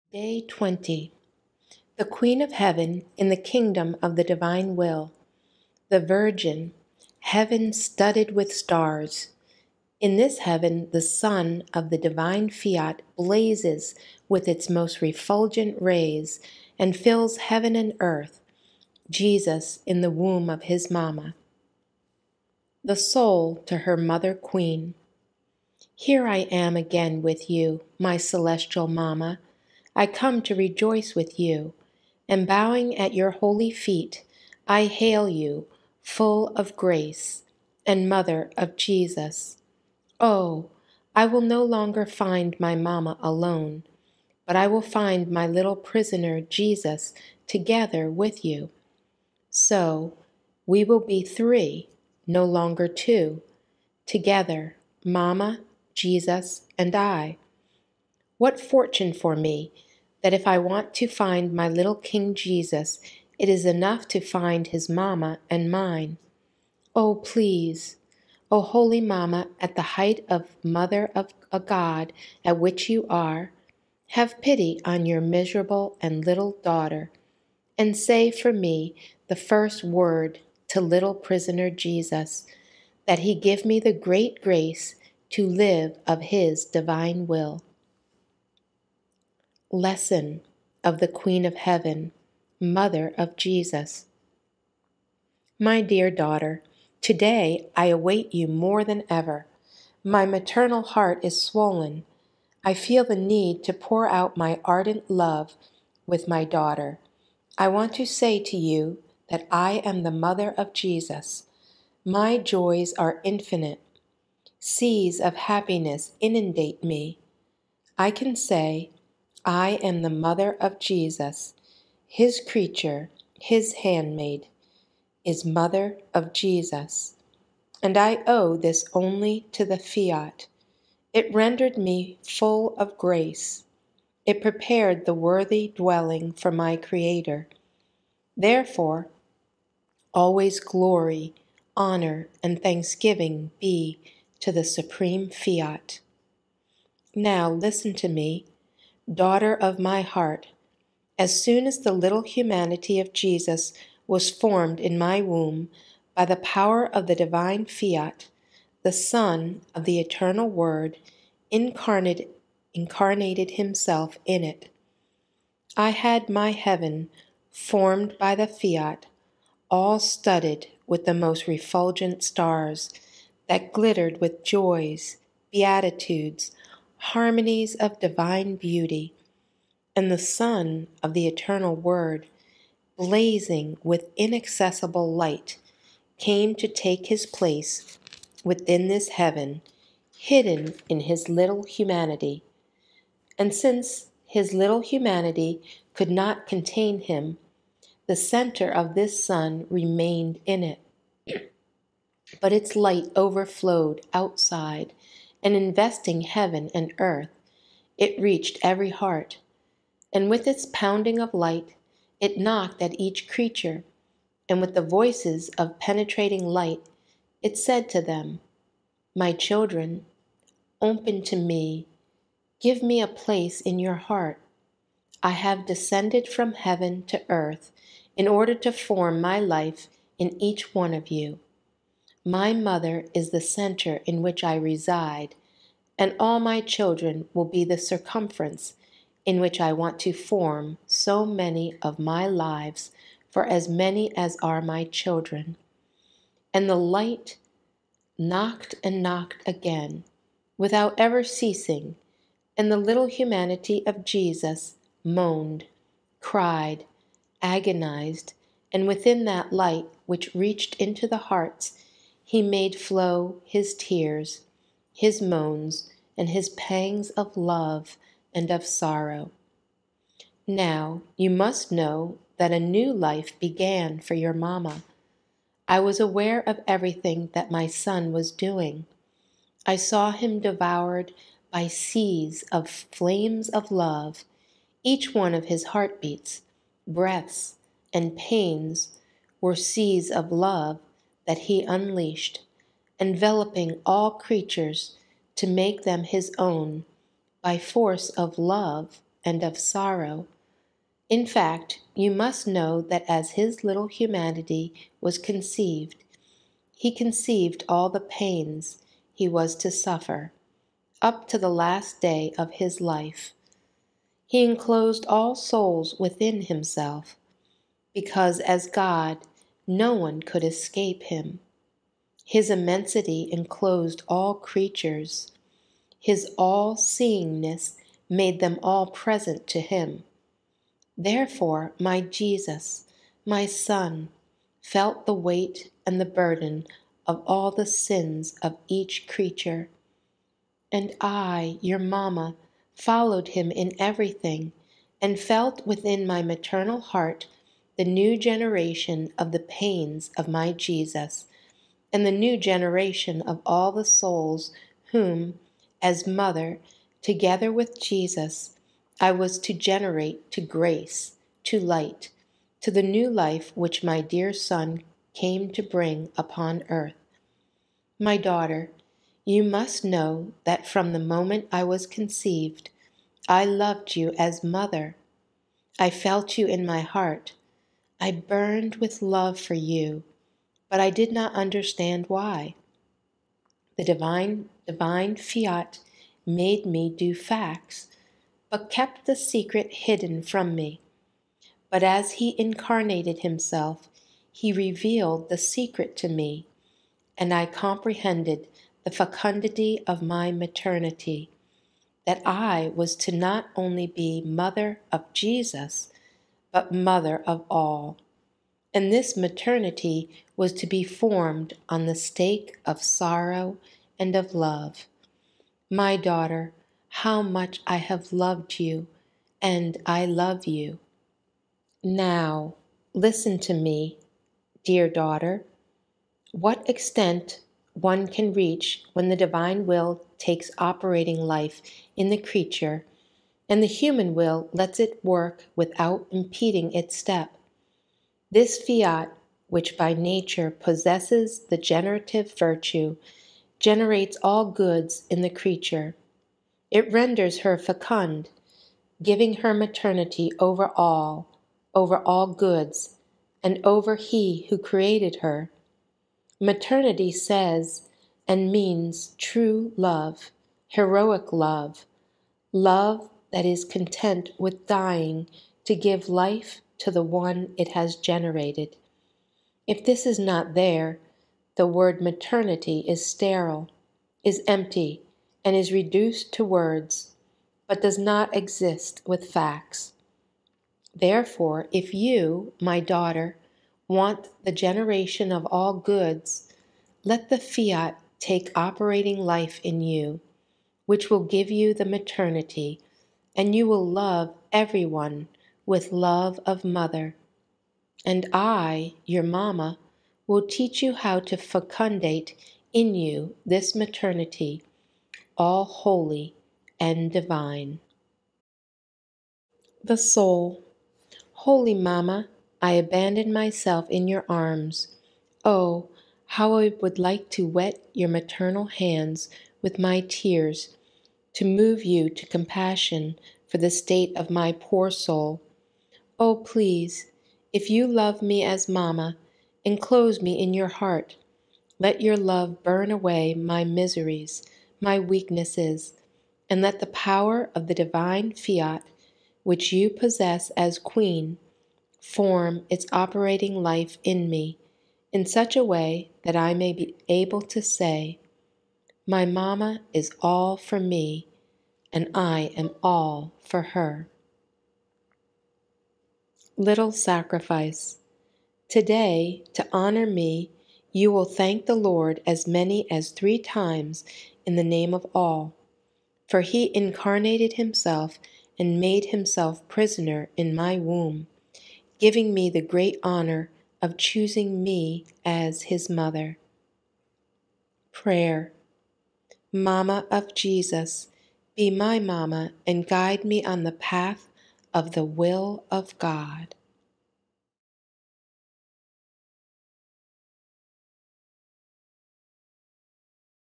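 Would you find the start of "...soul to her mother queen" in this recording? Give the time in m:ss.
0:22.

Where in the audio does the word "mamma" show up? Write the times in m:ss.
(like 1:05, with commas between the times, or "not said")
0:42, 0:55, 1:04, 1:08, 4:34, 5:41, 8:48.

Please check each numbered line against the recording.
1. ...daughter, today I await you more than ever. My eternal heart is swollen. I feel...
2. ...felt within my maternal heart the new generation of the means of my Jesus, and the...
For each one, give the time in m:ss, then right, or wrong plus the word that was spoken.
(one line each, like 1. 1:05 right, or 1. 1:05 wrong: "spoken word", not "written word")
1. 1:36 wrong: "maternal", not "eternal"
2. 5:45 wrong: "pains", not "means".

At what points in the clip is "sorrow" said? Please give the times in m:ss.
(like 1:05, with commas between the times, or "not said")
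4:28, 4:59, 6:52.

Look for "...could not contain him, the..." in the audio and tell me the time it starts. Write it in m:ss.
3:15.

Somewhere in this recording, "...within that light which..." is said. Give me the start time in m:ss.
4:18.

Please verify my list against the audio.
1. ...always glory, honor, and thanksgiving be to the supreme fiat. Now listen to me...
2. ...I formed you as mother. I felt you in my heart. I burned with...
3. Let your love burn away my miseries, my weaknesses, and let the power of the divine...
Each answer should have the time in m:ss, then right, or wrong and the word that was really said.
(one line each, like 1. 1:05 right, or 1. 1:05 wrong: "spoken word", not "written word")
1. 2:20 right
2. 6:13 wrong: "loved", not "formed"
3. 8:51 right.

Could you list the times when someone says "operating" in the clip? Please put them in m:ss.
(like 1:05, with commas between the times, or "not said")
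7:10, 8:08, 9:02.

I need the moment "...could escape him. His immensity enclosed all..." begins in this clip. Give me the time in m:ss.
5:20.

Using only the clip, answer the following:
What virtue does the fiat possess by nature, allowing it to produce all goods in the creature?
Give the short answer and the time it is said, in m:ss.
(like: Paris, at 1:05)
Generative virtue, at 7:21.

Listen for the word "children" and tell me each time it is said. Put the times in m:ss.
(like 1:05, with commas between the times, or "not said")
3:39, 3:56, 4:04.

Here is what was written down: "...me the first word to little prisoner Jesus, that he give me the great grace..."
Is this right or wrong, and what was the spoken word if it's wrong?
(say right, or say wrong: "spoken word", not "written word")
right.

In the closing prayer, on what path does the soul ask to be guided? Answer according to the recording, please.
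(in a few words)
The will of God.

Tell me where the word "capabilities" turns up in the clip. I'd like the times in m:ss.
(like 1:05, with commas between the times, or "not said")
not said.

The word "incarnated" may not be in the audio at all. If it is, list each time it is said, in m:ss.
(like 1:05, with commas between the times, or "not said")
2:41, 6:32, 9:26.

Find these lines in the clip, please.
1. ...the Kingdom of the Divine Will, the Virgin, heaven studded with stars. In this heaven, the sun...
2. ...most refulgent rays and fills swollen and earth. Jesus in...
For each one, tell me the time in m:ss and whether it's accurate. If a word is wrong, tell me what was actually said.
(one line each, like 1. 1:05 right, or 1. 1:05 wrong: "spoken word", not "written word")
1. 0:03 right
2. 0:14 wrong: "heaven", not "swollen".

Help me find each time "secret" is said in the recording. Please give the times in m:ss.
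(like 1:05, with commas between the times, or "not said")
6:29, 6:35.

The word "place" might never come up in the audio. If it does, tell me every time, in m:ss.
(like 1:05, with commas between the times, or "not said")
3:07, 3:43.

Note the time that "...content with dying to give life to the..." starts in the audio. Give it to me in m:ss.
7:43.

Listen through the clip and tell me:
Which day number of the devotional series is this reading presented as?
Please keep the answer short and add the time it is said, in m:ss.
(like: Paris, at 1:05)
Day 20, at 0:00.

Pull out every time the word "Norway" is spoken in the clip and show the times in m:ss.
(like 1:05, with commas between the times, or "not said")
not said.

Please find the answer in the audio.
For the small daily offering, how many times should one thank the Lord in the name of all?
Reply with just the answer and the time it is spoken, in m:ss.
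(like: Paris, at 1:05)
3, at 9:23.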